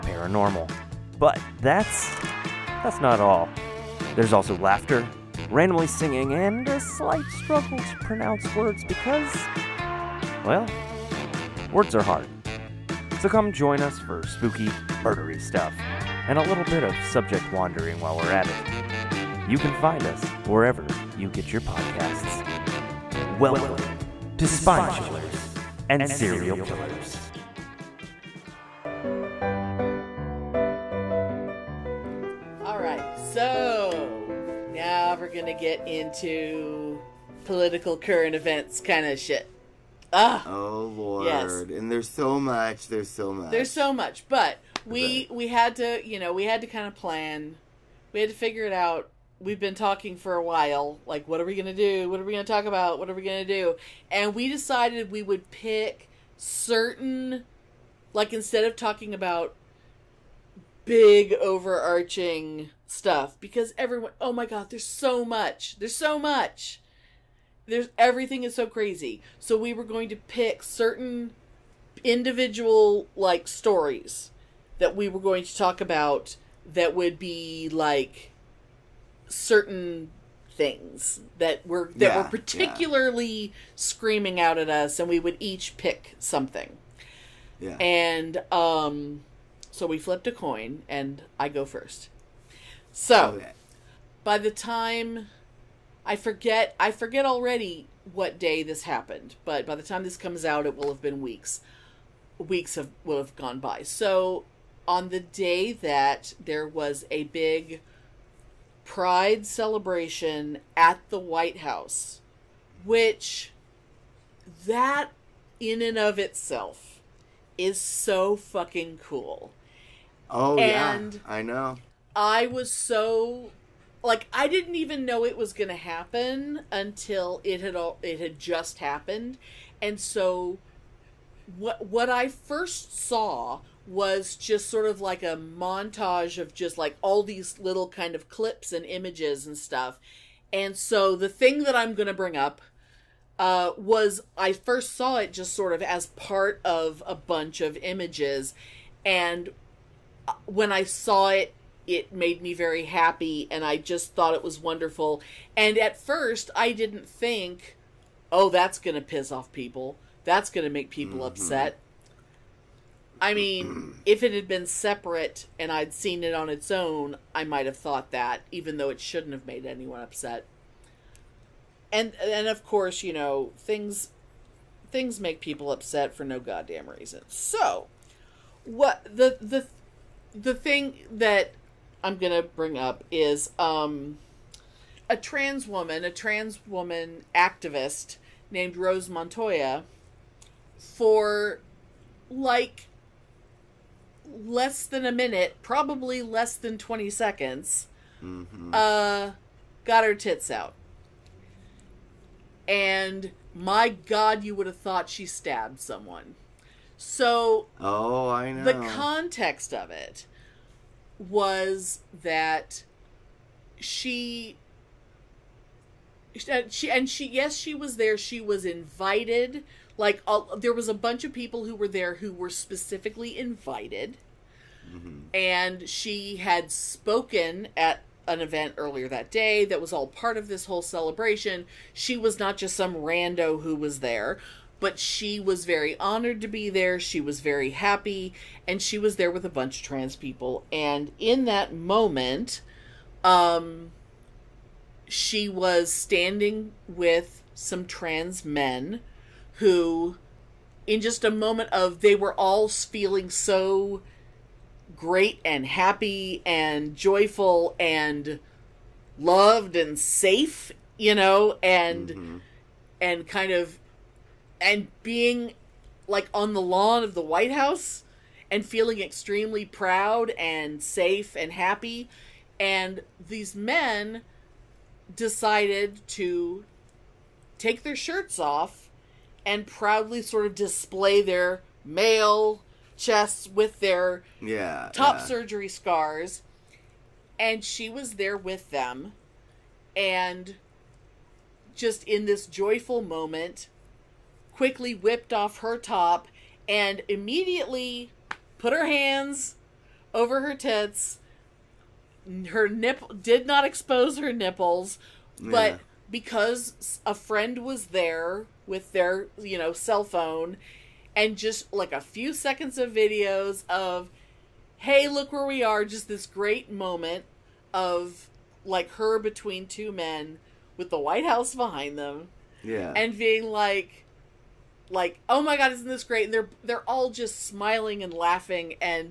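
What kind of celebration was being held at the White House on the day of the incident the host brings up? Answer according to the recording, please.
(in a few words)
Pride celebration.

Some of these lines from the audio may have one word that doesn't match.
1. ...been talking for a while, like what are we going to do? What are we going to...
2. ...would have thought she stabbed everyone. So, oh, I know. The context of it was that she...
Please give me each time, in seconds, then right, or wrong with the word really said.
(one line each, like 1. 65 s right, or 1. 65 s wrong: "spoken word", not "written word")
1. 49 s right
2. 204 s wrong: "someone", not "everyone".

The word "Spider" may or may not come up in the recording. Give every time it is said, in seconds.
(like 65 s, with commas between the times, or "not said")
not said.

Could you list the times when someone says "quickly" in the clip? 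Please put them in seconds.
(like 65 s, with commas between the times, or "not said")
294 s.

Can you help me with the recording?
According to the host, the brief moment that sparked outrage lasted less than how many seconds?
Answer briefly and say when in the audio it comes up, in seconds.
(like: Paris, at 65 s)
20, at 196 s.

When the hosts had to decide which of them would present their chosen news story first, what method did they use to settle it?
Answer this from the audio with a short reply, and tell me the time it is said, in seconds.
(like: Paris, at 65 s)
Flipped a coin, at 89 s.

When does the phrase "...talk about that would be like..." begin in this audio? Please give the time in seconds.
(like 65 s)
75 s.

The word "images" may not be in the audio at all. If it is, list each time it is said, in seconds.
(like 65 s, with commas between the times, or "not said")
138 s, 147 s.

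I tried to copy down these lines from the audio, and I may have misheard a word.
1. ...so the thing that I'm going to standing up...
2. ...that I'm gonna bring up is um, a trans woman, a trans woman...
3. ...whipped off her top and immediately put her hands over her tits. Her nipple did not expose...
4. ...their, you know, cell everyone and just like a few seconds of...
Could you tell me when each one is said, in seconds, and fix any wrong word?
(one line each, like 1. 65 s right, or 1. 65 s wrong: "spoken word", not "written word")
1. 140 s wrong: "bring", not "standing"
2. 181 s right
3. 294 s right
4. 308 s wrong: "phone", not "everyone".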